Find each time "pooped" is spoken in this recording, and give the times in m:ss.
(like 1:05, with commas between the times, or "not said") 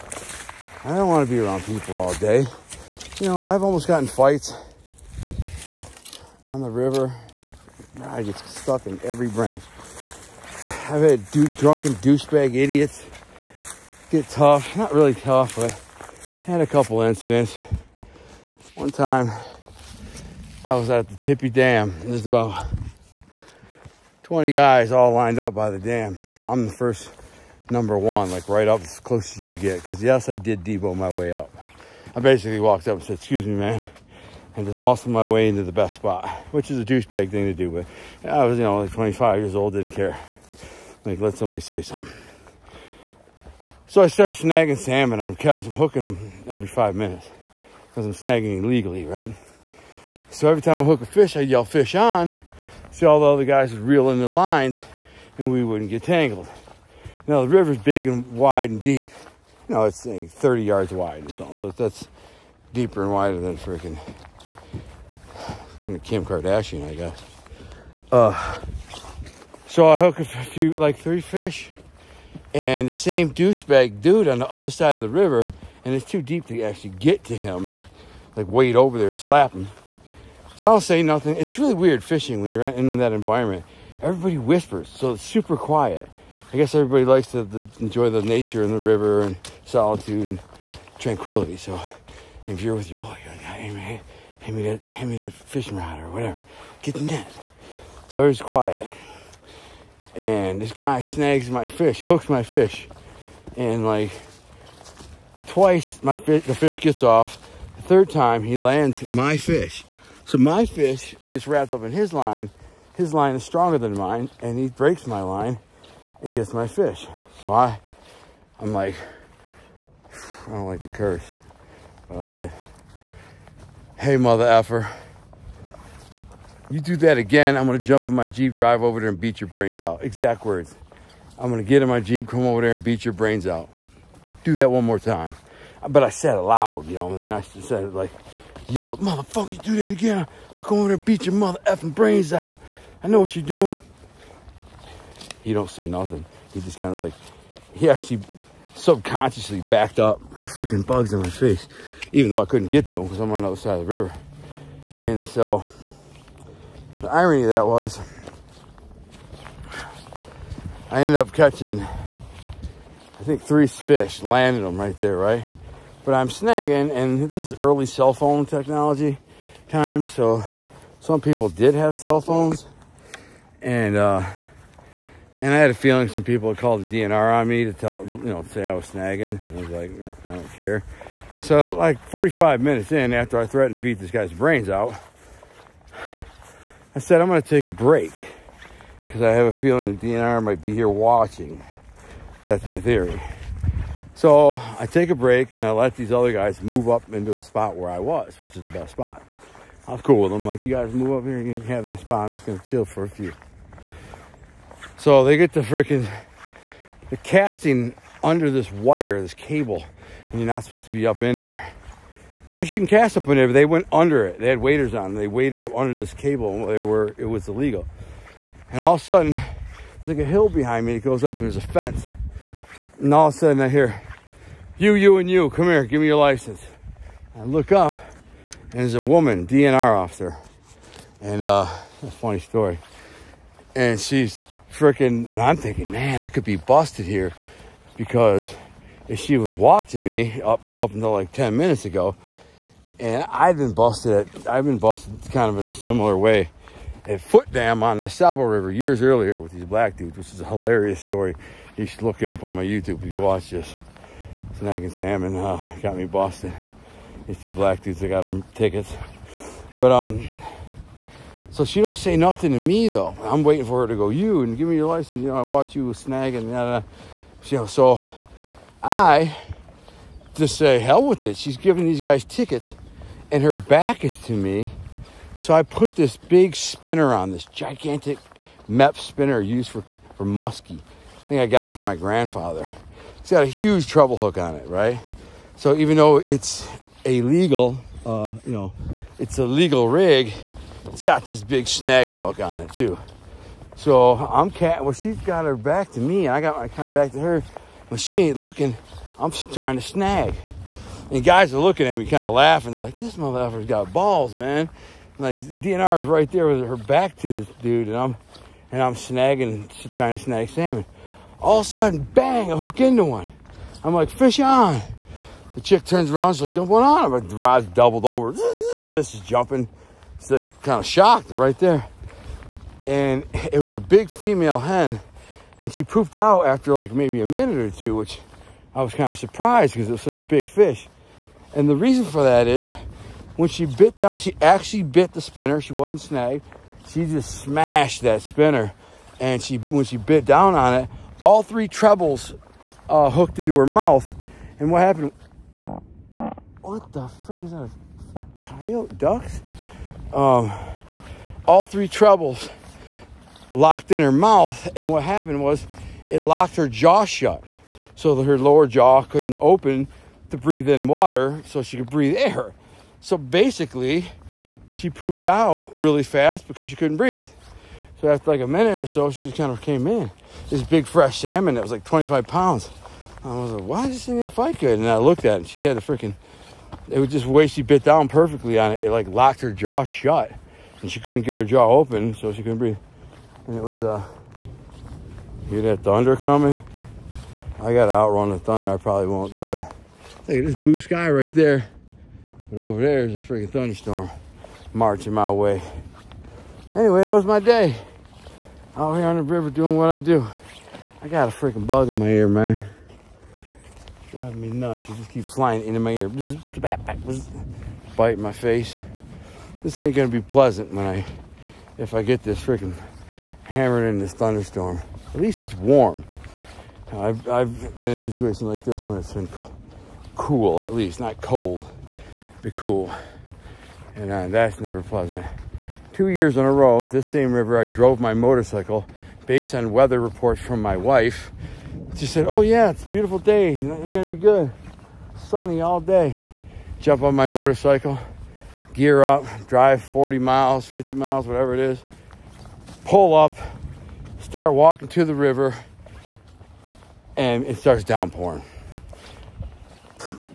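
5:25, 6:04.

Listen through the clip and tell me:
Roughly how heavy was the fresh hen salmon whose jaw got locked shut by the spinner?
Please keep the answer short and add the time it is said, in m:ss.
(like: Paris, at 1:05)
25 pounds, at 6:11.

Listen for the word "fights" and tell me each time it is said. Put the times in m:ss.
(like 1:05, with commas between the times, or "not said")
0:04, 6:14.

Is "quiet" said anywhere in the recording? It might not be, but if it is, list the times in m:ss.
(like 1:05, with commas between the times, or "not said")
1:25, 1:38.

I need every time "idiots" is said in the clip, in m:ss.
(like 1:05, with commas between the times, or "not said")
0:12.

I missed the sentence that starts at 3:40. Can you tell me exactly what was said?
It goes up, and there's a fence.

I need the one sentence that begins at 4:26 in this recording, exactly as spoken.
Yada, You know, so I just say hell with it.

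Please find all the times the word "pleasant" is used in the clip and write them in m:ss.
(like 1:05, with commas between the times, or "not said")
6:50, 7:04.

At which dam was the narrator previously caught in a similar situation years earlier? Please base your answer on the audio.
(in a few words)
Foote Dam.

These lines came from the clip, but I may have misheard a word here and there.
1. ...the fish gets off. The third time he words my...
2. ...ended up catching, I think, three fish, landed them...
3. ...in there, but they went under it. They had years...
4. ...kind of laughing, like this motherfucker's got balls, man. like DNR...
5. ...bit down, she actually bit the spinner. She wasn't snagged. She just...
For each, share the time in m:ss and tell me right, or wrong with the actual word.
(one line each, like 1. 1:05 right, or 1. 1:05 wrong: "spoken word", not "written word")
1. 1:46 wrong: "lands", not "words"
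2. 2:41 right
3. 3:33 wrong: "waders", not "years"
4. 5:02 right
5. 5:33 right.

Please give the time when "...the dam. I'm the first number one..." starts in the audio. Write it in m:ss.
0:25.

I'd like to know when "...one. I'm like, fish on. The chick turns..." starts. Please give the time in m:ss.
5:13.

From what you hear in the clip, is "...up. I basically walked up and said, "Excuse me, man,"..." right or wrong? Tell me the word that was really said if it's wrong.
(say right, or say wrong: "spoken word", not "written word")
right.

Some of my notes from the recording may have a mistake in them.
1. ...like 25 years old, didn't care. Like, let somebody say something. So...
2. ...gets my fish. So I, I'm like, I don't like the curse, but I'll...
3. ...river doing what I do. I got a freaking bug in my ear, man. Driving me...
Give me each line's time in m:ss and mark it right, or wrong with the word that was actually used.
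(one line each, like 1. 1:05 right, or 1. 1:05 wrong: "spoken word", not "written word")
1. 0:38 right
2. 1:56 right
3. 6:39 right.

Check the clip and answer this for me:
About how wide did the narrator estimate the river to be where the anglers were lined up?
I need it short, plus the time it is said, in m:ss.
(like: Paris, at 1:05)
30 yards, at 1:00.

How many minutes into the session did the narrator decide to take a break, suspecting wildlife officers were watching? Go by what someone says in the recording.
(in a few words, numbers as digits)
45.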